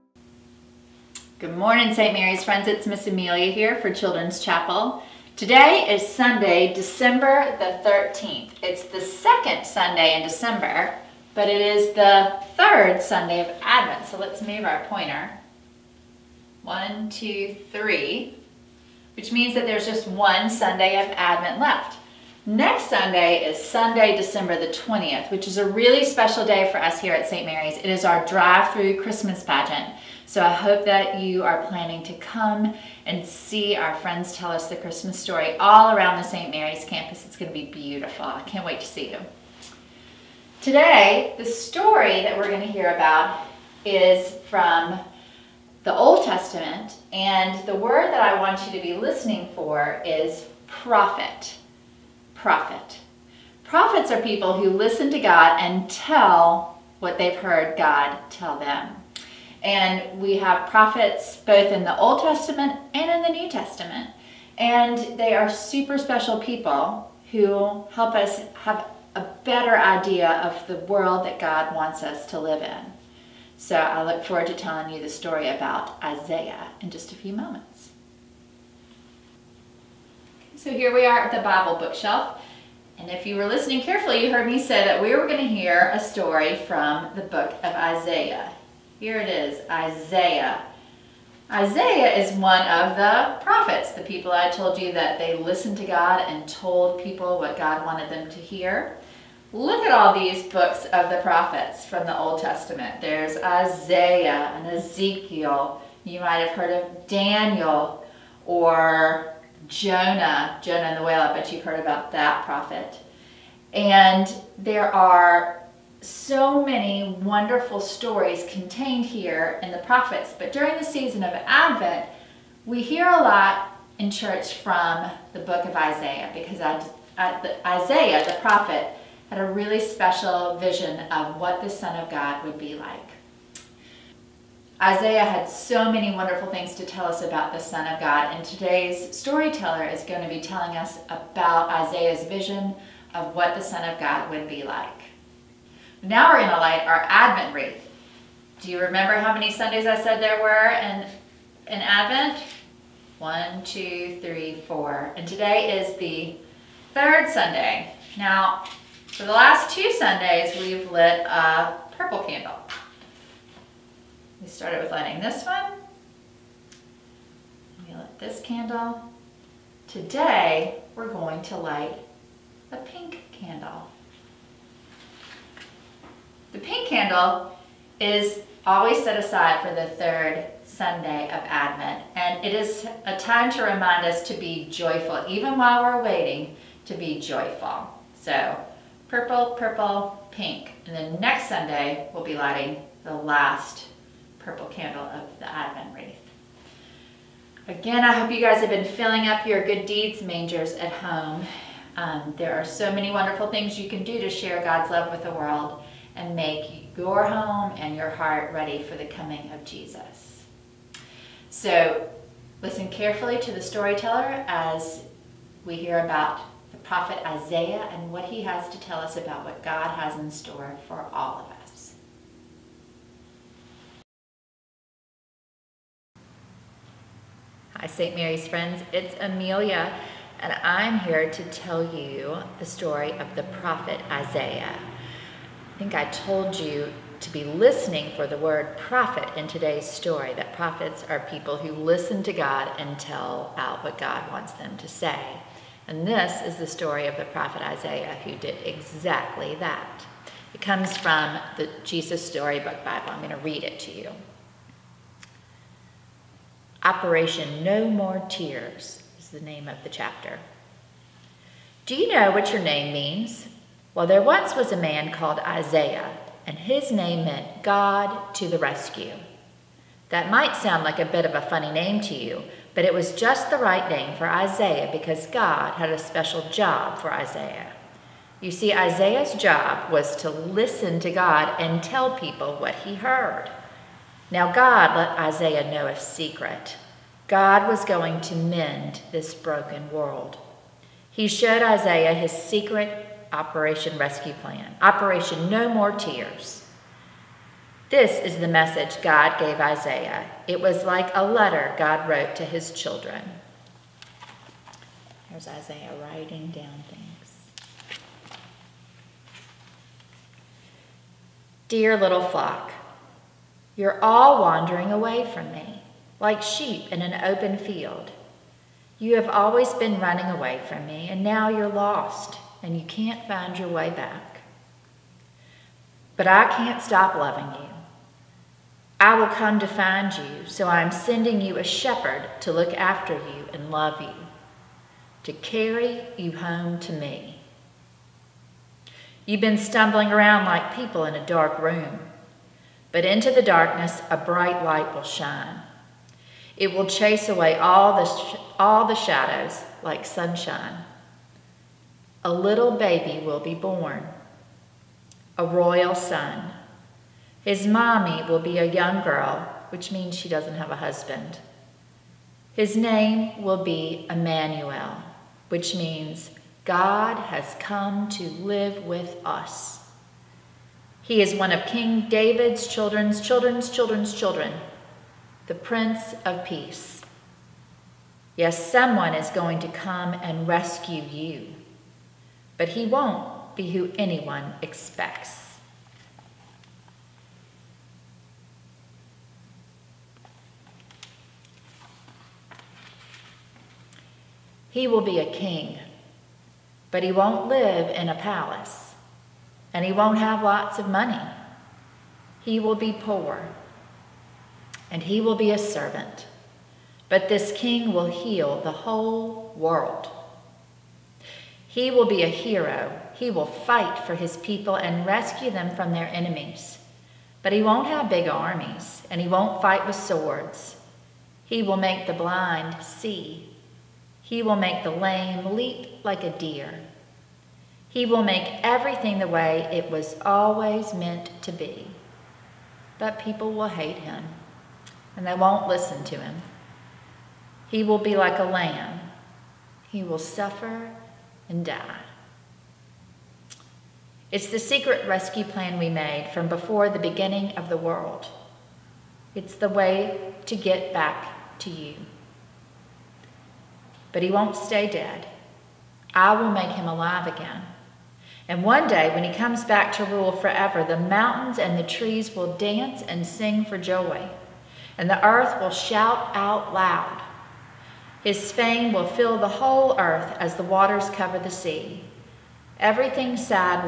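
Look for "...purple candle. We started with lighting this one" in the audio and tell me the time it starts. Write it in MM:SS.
02:41.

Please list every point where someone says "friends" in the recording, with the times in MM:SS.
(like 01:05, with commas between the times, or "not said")
00:02, 00:33, 03:48.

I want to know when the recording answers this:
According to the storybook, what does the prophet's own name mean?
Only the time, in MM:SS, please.
04:27.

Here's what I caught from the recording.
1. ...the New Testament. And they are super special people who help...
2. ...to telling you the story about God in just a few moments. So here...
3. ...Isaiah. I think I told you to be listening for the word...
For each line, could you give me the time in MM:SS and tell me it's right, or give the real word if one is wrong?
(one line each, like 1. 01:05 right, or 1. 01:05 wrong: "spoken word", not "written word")
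1. 01:03 right
2. 01:14 wrong: "Isaiah", not "God"
3. 03:54 right.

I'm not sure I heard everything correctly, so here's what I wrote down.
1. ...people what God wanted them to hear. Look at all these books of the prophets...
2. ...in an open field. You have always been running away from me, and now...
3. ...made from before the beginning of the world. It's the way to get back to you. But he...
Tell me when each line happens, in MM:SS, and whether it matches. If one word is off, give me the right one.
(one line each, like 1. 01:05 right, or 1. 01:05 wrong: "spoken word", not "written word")
1. 01:37 right
2. 05:16 right
3. 07:25 right.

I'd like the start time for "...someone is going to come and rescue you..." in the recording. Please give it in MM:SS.
06:18.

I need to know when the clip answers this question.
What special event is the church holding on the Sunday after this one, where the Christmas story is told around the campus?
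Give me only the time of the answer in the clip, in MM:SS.
00:28.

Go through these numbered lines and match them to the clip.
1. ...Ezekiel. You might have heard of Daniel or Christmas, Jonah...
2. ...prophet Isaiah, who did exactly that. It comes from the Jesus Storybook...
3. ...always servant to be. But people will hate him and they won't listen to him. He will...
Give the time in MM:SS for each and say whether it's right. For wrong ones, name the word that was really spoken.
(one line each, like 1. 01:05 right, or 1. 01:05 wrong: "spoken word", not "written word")
1. 01:44 wrong: "Jonah", not "Christmas"
2. 04:07 right
3. 07:10 wrong: "meant", not "servant".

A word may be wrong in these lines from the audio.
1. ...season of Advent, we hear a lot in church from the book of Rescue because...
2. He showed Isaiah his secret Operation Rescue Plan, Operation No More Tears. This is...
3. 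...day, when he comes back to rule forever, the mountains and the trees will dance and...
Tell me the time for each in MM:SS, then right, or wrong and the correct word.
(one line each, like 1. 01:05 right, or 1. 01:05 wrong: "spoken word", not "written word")
1. 02:00 wrong: "Isaiah", not "Rescue"
2. 04:51 right
3. 07:38 right.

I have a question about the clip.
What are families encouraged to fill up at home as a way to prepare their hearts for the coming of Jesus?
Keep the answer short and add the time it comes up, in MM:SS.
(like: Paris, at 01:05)
Good deeds mangers, at 03:19.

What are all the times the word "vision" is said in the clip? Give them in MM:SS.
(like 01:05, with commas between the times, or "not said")
02:10, 02:22.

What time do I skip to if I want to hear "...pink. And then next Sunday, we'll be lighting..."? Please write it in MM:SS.
03:10.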